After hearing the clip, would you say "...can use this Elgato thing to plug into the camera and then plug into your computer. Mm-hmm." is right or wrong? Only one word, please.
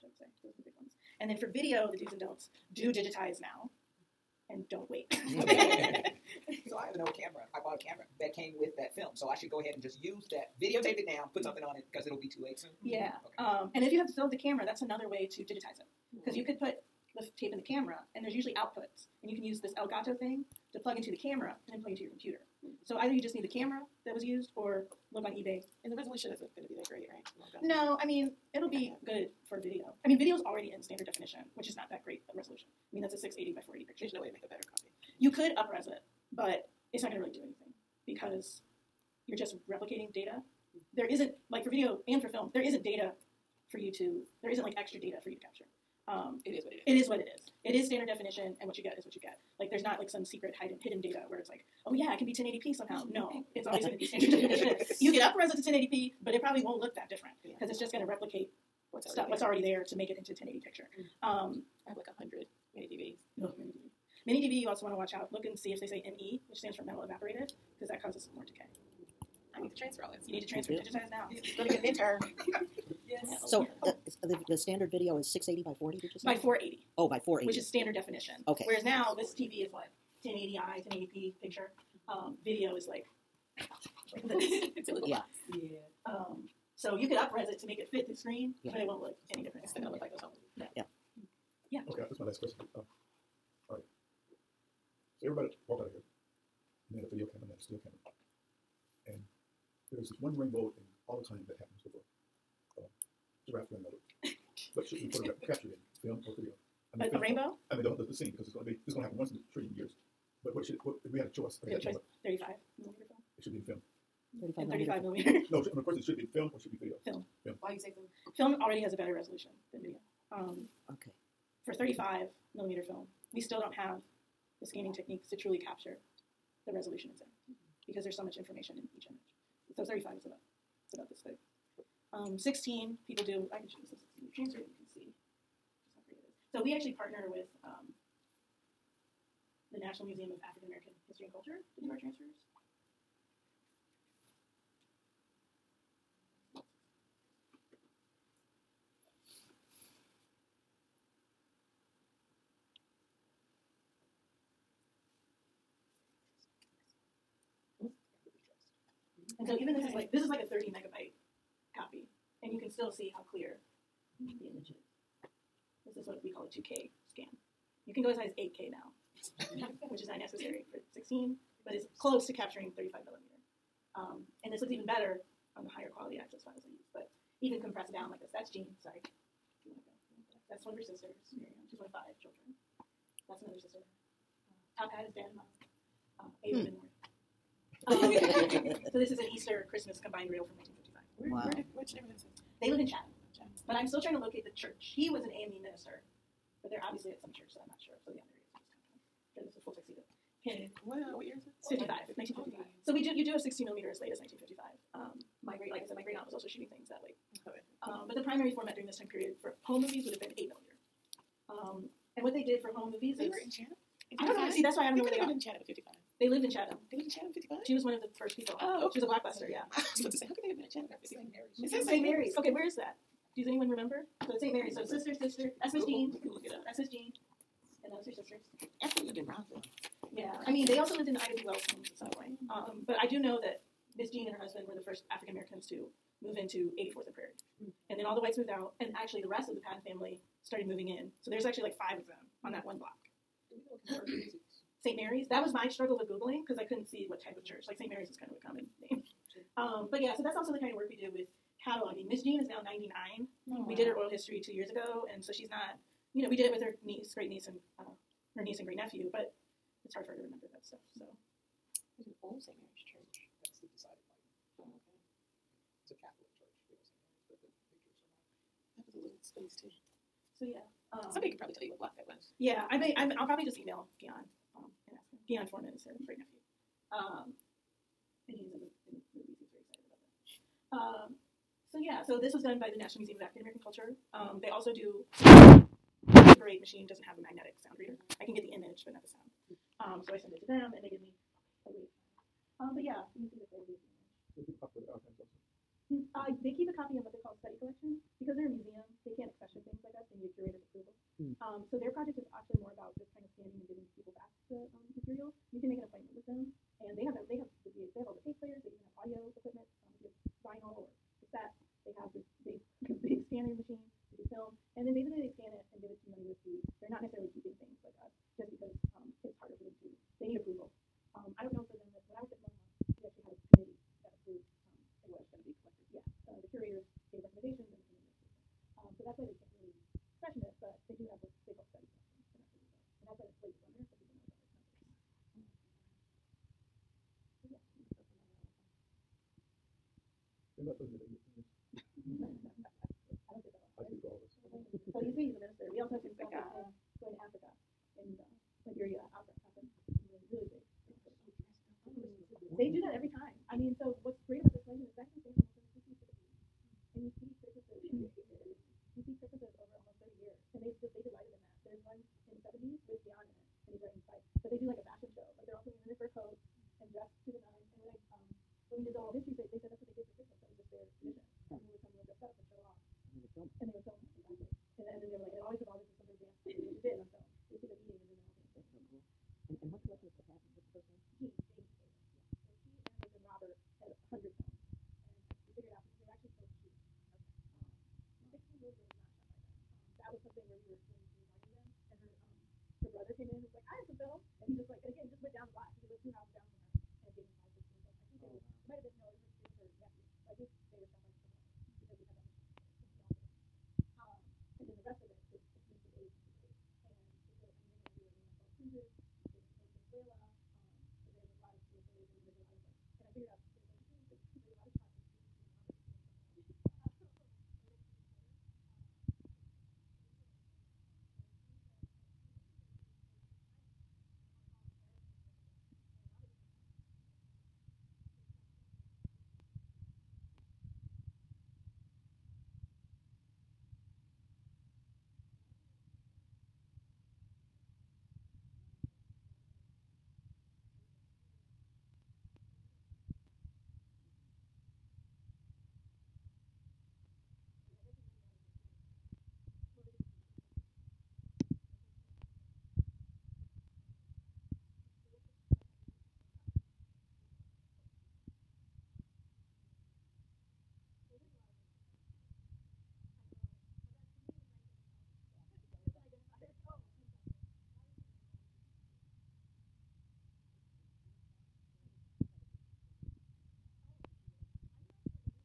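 right.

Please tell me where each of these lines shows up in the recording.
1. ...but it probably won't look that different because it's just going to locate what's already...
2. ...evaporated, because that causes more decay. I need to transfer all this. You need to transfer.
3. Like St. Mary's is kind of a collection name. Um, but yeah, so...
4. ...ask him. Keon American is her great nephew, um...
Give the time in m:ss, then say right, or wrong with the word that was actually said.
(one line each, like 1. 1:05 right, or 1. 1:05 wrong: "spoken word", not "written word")
1. 0:56 wrong: "replicate", not "locate"
2. 1:07 right
3. 4:07 wrong: "common", not "collection"
4. 4:34 wrong: "Foreman", not "American".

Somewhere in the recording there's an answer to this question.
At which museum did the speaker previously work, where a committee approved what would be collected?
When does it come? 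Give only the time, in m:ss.
5:22.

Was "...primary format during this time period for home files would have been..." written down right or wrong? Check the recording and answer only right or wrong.
wrong.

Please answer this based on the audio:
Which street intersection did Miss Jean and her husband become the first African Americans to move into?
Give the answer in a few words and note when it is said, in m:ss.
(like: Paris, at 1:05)
84th and Prairie, at 3:56.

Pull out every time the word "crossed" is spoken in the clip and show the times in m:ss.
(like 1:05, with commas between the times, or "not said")
not said.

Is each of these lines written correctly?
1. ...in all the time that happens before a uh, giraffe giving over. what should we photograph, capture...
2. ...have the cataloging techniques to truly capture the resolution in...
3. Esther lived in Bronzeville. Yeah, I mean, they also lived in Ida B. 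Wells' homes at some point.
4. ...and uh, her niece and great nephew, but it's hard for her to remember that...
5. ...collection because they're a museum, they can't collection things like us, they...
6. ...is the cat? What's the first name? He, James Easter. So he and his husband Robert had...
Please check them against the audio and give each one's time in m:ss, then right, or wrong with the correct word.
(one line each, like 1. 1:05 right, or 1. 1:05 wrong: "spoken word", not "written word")
1. 1:40 wrong: "running", not "giving"
2. 2:03 wrong: "scanning", not "cataloging"
3. 3:48 right
4. 4:17 right
5. 4:57 wrong: "accession", not "collection"
6. 6:20 wrong: "Taylor", not "Easter".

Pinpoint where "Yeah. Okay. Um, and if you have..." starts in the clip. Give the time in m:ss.
0:12.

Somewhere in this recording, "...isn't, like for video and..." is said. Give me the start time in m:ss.
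0:41.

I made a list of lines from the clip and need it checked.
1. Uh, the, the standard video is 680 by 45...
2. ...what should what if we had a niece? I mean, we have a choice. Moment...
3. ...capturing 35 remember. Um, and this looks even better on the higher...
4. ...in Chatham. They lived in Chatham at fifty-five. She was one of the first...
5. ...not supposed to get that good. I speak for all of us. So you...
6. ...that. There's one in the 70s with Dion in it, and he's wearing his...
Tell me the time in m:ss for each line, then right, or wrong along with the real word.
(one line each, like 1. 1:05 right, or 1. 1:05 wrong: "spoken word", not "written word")
1. 1:13 wrong: "40", not "45"
2. 1:50 wrong: "choice", not "niece"
3. 2:52 wrong: "millimeter", not "remember"
4. 3:36 right
5. 5:40 right
6. 6:01 right.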